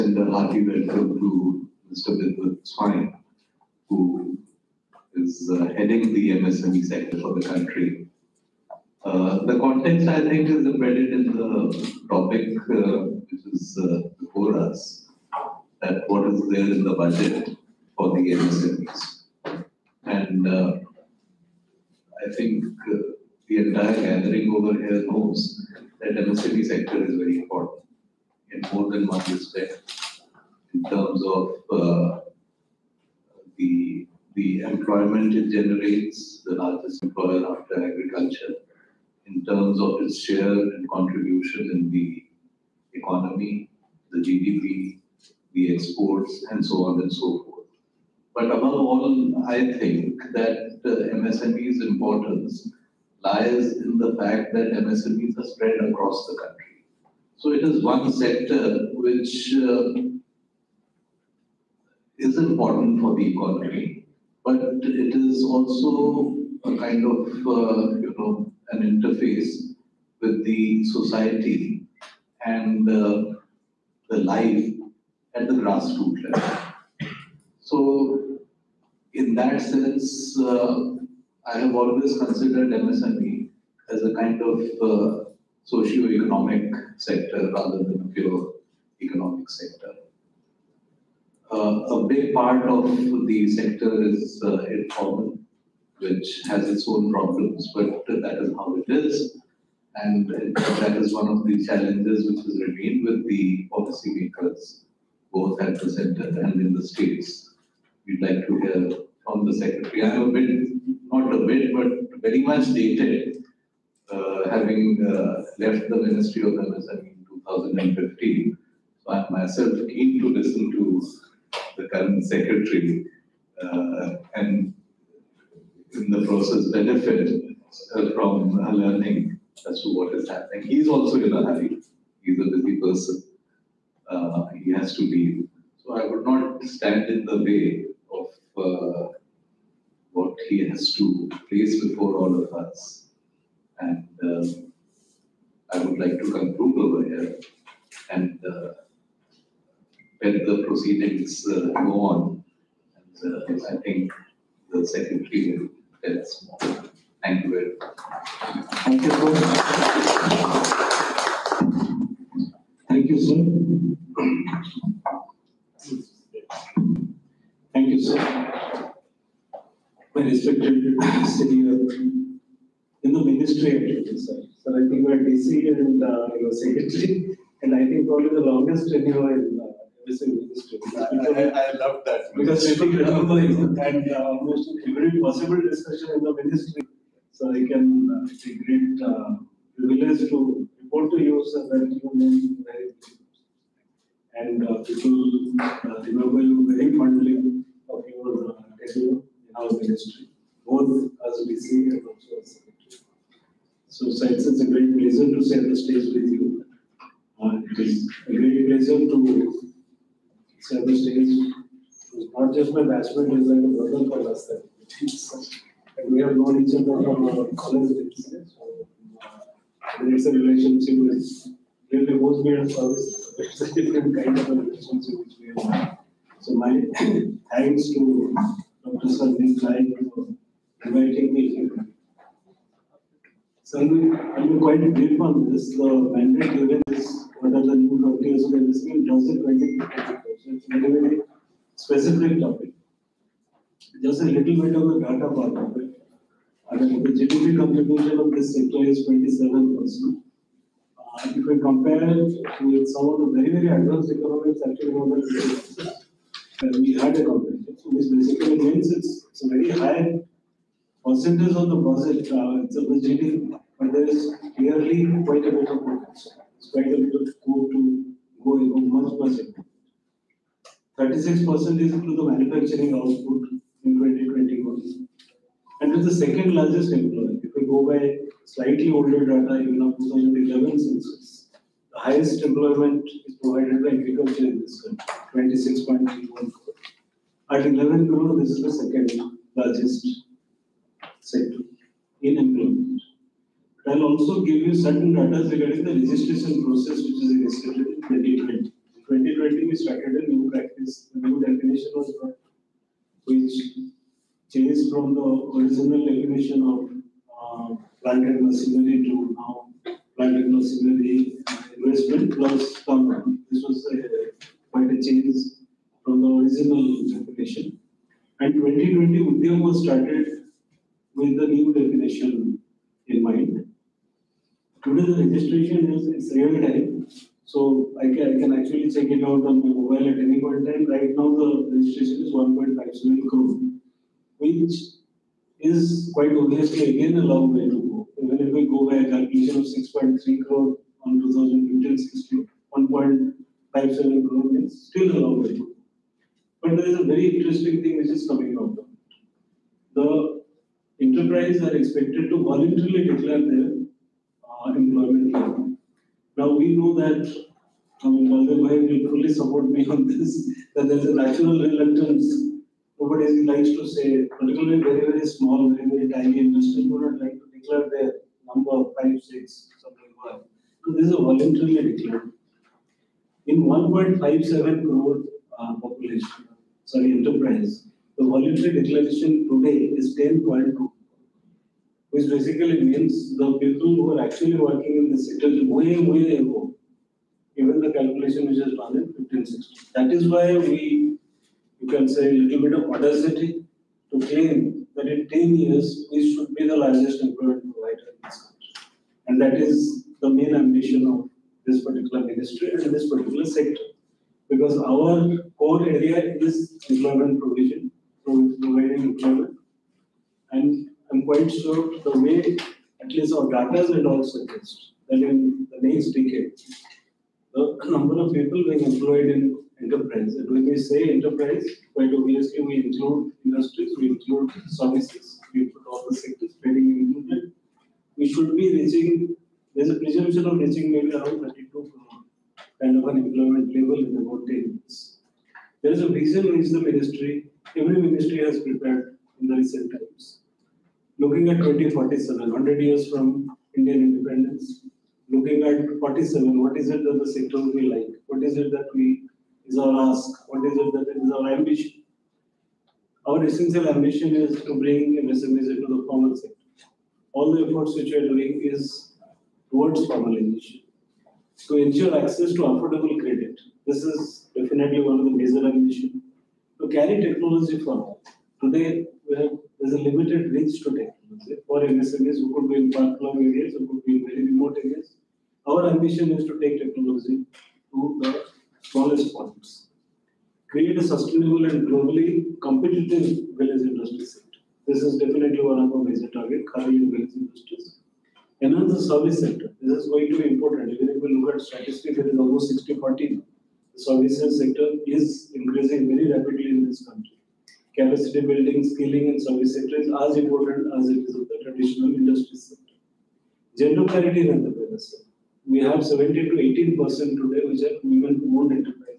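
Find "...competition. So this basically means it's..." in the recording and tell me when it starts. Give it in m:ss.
4:17.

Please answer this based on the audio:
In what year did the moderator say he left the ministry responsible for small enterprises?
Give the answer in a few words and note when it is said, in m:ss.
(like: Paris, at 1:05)
2015, at 1:57.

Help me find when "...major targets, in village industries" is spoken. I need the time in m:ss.
8:06.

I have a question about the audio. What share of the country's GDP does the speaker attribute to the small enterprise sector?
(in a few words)
27%.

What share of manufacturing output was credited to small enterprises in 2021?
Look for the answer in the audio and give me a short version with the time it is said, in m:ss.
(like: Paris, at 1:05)
36%, at 4:30.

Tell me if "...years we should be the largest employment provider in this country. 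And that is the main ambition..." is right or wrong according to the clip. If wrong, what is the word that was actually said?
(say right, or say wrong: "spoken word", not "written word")
right.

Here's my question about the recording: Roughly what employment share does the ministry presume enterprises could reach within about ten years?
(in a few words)
32 percent.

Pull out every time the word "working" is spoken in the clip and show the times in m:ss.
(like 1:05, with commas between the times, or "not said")
6:24.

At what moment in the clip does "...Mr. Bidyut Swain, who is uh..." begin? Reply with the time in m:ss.
0:01.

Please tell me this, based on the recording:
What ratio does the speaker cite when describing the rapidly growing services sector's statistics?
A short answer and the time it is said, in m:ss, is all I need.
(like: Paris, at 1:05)
60 40, at 8:12.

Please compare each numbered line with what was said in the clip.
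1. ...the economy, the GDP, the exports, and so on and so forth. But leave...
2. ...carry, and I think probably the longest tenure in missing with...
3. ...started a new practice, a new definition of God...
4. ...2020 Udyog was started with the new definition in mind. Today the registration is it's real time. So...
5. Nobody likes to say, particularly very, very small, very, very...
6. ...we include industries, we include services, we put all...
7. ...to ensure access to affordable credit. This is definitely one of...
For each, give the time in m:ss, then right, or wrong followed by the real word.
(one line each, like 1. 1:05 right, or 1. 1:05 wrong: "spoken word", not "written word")
1. 0:41 wrong: "above", not "leave"
2. 2:56 wrong: "secretary", not "carry"
3. 4:59 right
4. 5:18 right
5. 6:02 right
6. 7:02 right
7. 7:41 right.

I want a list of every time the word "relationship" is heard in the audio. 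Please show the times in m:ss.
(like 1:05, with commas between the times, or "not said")
3:40, 3:44.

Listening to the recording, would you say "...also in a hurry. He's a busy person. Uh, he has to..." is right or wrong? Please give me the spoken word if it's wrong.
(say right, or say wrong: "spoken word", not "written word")
right.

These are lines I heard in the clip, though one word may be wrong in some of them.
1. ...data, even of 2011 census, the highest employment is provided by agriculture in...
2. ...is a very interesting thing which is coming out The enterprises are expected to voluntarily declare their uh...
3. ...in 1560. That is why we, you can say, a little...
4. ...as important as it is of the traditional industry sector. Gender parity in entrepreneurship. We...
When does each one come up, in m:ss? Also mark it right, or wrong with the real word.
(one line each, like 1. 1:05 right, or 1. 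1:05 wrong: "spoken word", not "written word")
1. 4:39 right
2. 5:46 right
3. 6:28 right
4. 8:20 right.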